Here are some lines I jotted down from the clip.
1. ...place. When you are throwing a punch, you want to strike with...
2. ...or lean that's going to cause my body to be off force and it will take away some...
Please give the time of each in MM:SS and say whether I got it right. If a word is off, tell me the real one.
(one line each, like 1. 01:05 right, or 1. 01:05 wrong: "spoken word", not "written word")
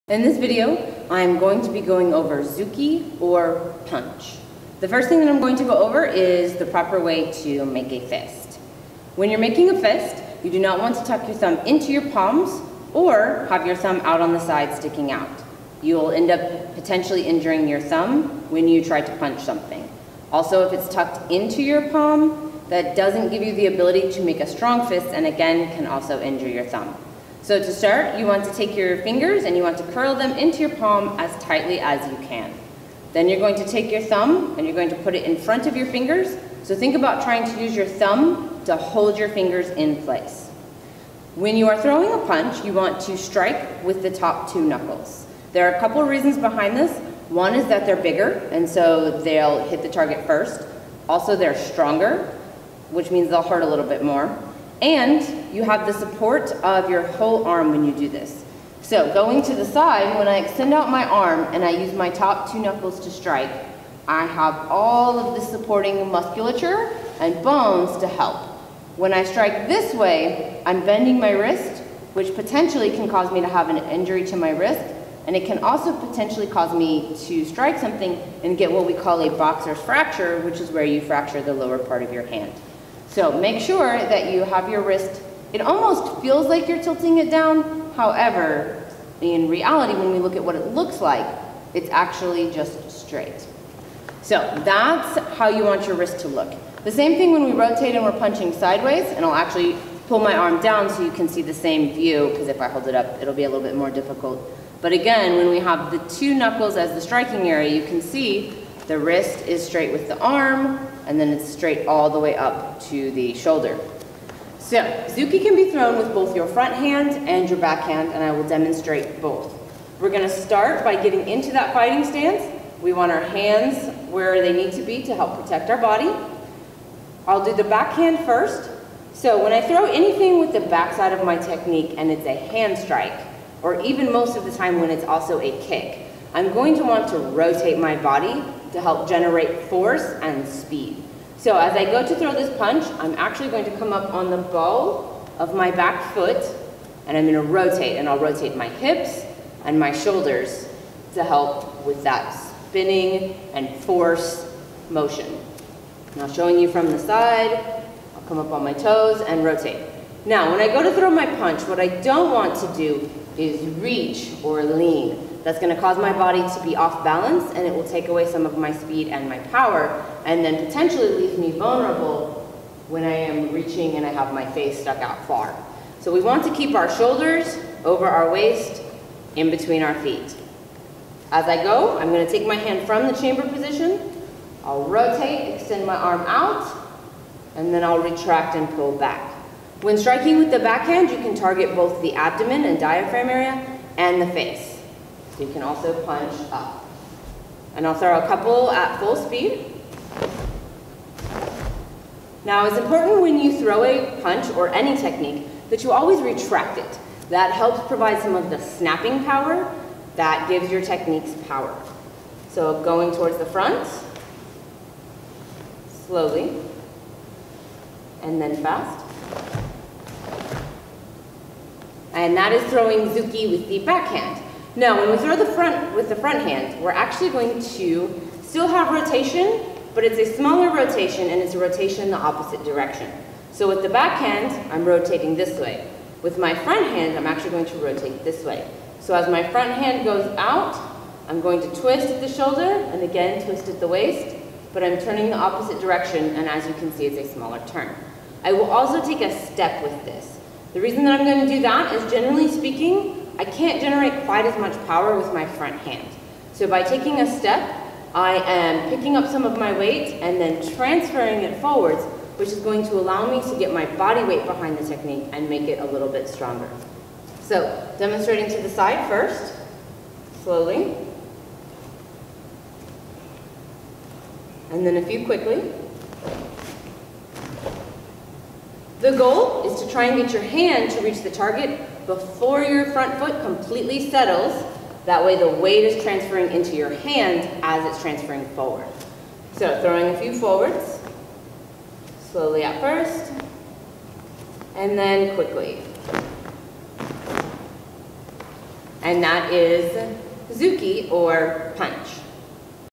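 1. 00:40 right
2. 02:44 wrong: "balance", not "force".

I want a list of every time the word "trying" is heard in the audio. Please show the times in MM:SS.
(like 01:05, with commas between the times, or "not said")
00:37.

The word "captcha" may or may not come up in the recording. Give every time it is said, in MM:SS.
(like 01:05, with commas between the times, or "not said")
not said.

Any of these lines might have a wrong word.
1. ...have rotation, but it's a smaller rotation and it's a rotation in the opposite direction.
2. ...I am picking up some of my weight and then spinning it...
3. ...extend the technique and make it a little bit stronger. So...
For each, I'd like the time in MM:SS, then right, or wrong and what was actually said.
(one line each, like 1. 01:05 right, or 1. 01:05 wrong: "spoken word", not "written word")
1. 03:48 right
2. 04:18 wrong: "transferring", not "spinning"
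3. 04:24 wrong: "behind", not "extend".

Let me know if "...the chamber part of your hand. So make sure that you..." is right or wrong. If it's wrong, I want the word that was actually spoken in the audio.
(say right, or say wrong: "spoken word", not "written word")
wrong: "lower", not "chamber".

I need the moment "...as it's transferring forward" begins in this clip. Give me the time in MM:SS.
04:47.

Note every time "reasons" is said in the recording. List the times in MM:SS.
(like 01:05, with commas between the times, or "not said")
00:46, 04:10.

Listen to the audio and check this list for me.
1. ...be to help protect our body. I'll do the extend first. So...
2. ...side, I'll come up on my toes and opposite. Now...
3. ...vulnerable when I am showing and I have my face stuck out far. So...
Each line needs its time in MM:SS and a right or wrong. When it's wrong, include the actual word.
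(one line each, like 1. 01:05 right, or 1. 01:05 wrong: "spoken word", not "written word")
1. 02:04 wrong: "backhand", not "extend"
2. 02:36 wrong: "rotate", not "opposite"
3. 02:51 wrong: "reaching", not "showing".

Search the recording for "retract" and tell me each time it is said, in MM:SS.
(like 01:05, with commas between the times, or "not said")
03:07, 03:26.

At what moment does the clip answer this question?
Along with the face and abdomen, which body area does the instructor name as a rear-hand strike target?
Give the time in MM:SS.
03:12.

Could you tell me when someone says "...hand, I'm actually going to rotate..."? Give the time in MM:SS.
03:56.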